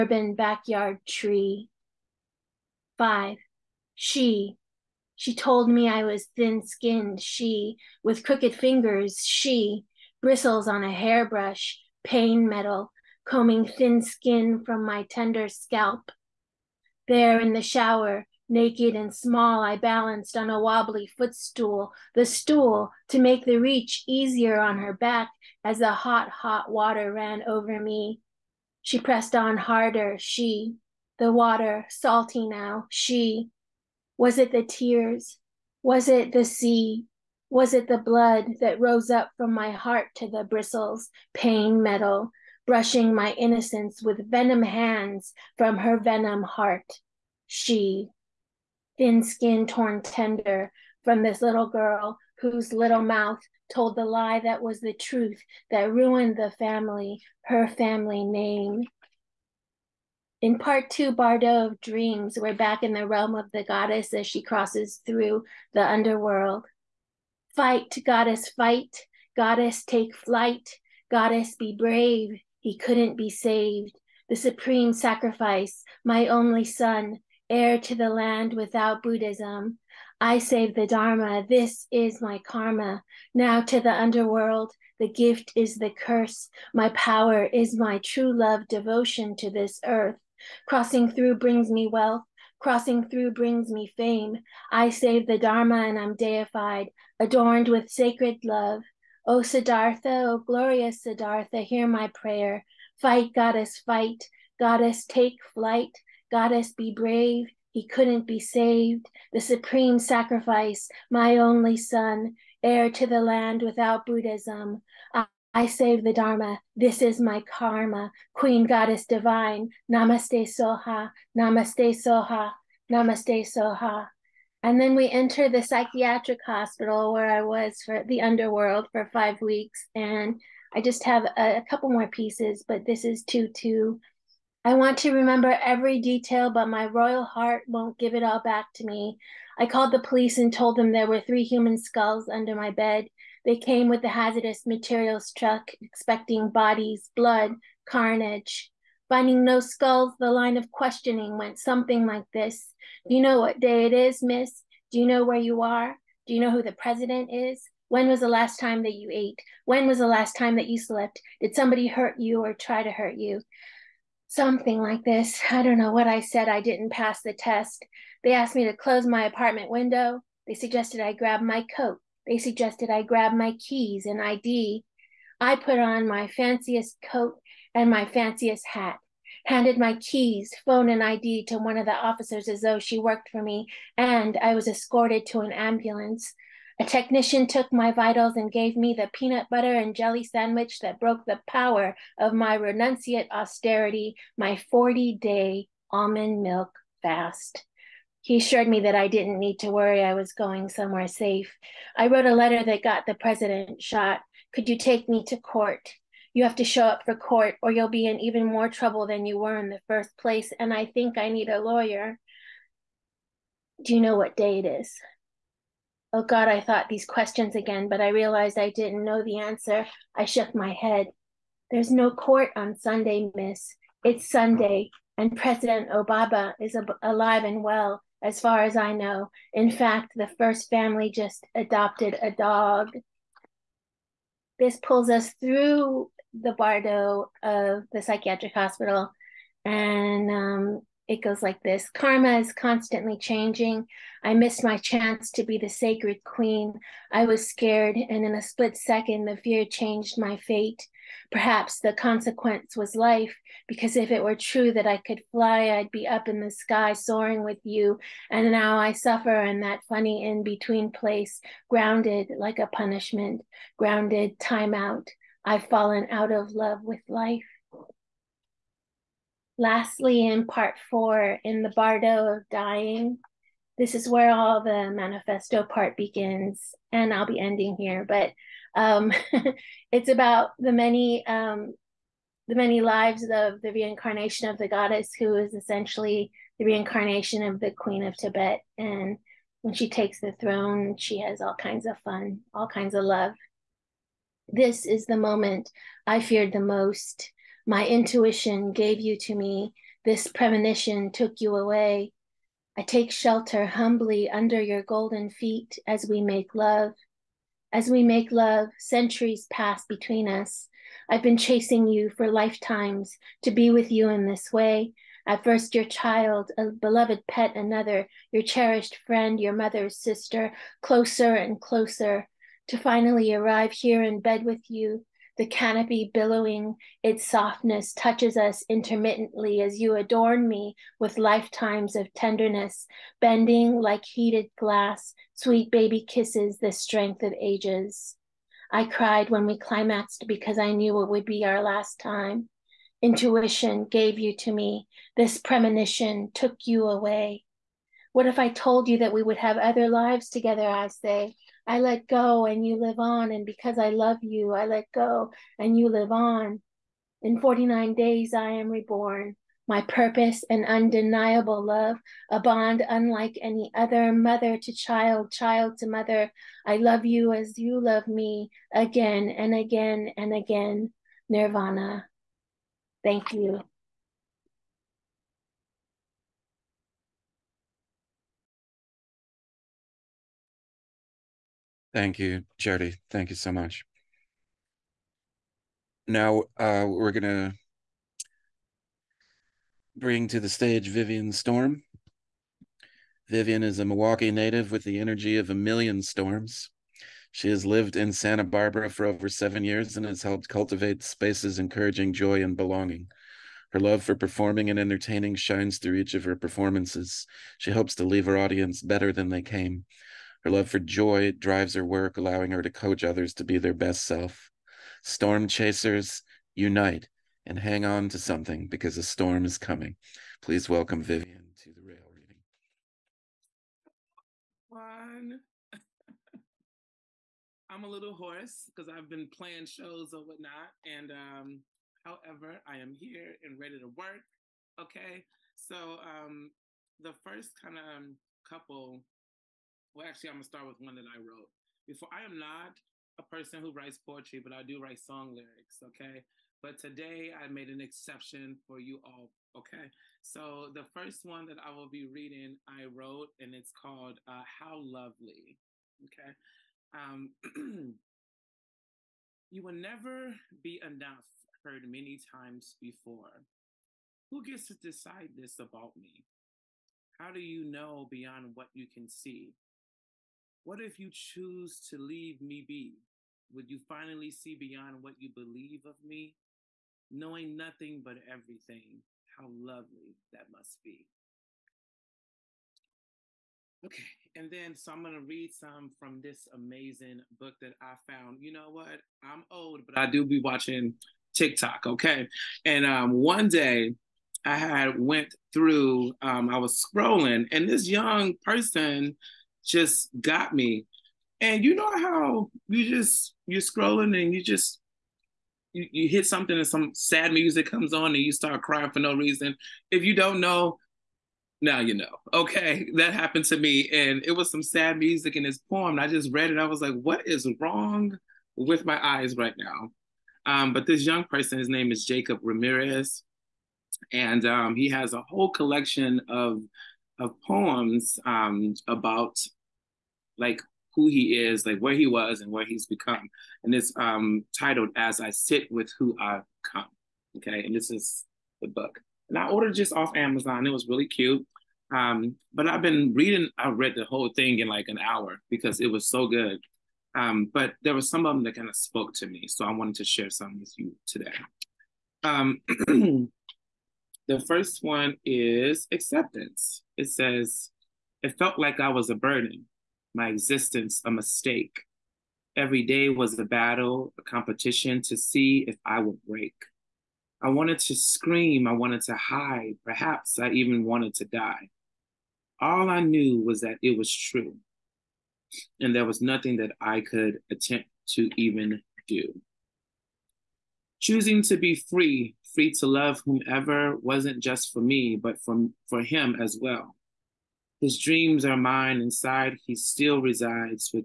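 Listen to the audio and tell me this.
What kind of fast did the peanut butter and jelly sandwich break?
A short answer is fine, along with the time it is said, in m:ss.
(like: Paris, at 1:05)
40 day almond milk fast, at 3:14.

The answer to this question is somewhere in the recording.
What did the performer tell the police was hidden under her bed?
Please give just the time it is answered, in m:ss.
2:21.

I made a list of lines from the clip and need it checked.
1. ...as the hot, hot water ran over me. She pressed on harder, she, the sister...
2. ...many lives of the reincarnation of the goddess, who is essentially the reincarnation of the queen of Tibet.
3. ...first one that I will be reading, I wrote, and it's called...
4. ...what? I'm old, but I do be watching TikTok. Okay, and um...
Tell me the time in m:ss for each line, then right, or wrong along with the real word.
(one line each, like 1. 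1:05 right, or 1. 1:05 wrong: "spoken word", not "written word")
1. 0:25 wrong: "water", not "sister"
2. 4:42 right
3. 7:30 right
4. 8:08 right.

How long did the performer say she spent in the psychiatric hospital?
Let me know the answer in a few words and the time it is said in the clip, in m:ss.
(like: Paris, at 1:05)
5 weeks, at 2:09.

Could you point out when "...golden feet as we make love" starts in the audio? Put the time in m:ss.
5:04.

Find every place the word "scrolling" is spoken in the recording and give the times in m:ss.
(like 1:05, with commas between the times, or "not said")
8:16, 8:23.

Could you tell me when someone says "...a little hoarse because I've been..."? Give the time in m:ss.
7:07.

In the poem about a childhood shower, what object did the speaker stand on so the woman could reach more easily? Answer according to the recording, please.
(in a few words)
wobbly footstool.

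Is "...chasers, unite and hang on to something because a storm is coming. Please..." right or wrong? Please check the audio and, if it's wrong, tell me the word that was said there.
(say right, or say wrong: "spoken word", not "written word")
right.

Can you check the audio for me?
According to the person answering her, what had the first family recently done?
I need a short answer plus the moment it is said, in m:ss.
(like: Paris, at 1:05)
adopted a dog, at 3:51.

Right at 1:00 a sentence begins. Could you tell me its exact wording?
In part two, Bardo of Dreams, we're back in the realm of the goddess as she crosses through the underworld.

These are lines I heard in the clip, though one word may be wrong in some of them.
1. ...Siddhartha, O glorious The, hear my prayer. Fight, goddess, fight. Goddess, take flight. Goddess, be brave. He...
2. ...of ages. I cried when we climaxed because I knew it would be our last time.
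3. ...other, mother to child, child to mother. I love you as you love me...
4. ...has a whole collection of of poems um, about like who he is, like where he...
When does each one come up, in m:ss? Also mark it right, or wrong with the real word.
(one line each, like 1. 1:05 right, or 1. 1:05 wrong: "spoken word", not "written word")
1. 1:39 wrong: "Siddhartha", not "The"
2. 5:37 right
3. 6:03 right
4. 8:44 right.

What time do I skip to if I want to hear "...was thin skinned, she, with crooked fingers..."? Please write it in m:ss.
0:06.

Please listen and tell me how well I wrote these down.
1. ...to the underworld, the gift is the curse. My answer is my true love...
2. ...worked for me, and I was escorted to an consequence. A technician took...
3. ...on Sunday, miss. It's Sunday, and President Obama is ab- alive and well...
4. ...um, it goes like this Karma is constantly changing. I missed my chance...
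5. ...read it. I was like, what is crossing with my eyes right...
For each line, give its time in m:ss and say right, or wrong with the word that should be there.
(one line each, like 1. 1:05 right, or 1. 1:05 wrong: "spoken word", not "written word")
1. 1:23 wrong: "power", not "answer"
2. 3:02 wrong: "ambulance", not "consequence"
3. 3:42 right
4. 4:00 right
5. 8:36 wrong: "wrong", not "crossing".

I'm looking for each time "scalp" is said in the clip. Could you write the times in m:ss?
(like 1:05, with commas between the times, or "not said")
0:15.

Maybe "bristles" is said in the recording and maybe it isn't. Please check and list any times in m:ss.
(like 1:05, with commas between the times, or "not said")
0:10, 0:40.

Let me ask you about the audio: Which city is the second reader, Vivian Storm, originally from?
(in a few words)
Milwaukee.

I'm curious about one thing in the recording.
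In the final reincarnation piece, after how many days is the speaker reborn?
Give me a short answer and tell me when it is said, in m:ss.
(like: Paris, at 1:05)
49, at 5:57.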